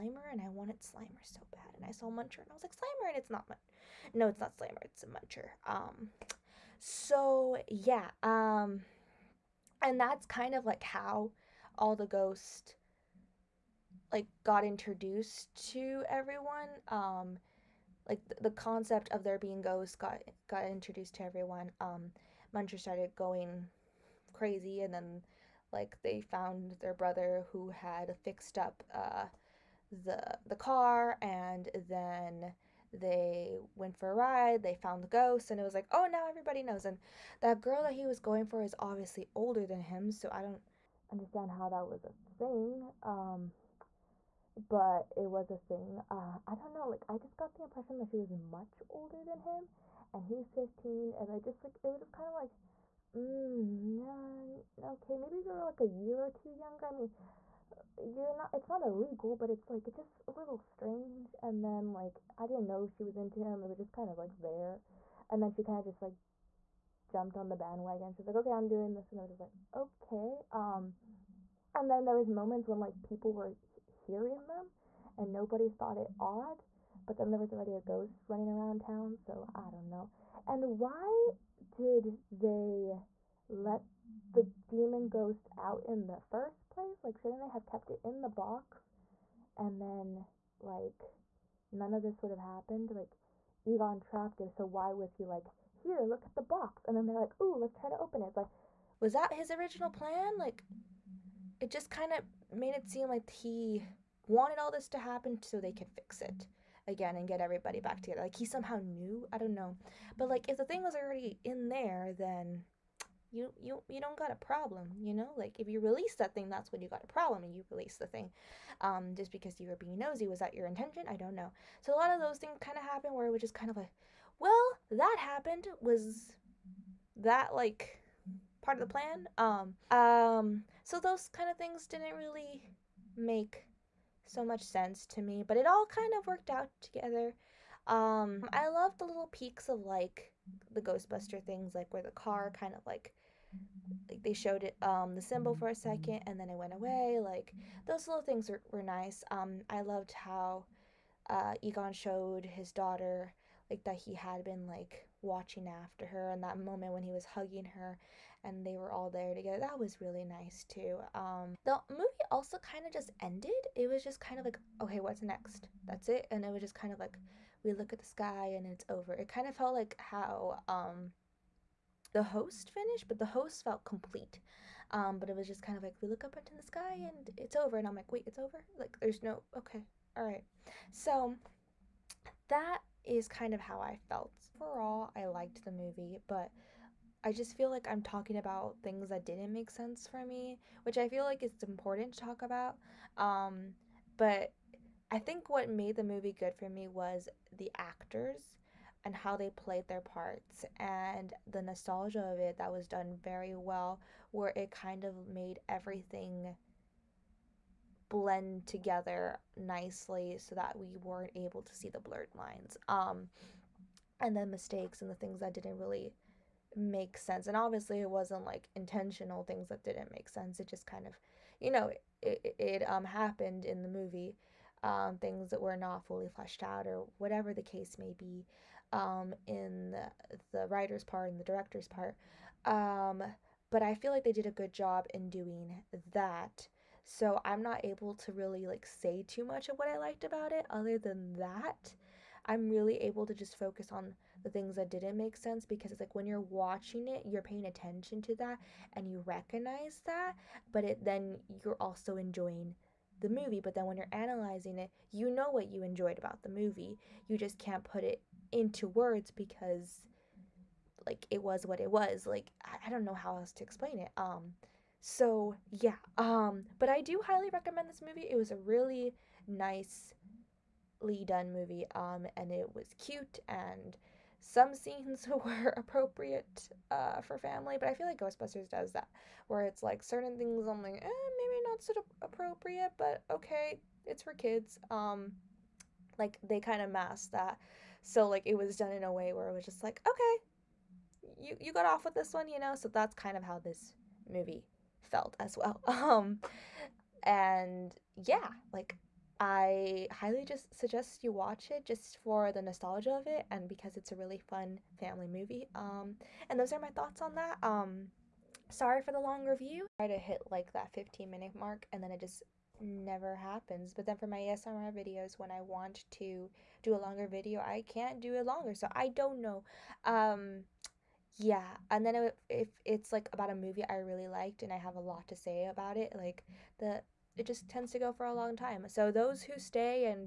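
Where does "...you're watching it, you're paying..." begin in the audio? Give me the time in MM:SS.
04:06.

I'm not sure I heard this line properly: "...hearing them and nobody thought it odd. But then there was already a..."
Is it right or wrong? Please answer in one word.
right.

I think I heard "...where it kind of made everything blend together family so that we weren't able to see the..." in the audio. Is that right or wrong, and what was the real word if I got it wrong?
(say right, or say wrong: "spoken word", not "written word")
wrong: "nicely", not "family".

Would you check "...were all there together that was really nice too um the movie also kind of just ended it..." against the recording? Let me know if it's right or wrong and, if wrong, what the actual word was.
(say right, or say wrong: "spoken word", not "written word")
right.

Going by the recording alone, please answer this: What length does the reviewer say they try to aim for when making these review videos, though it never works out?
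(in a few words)
15 minutes.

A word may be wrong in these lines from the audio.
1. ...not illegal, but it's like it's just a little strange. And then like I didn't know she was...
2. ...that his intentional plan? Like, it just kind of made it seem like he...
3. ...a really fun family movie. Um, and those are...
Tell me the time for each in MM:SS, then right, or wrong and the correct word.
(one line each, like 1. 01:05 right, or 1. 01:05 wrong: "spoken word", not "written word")
1. 00:58 right
2. 01:39 wrong: "original", not "intentional"
3. 05:04 right.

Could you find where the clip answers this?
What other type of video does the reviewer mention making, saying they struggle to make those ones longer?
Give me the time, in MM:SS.
05:14.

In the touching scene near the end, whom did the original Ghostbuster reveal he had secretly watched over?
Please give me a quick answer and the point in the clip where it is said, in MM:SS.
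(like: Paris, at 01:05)
his daughter, at 02:32.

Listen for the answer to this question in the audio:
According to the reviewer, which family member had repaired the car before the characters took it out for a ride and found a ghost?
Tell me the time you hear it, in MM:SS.
00:26.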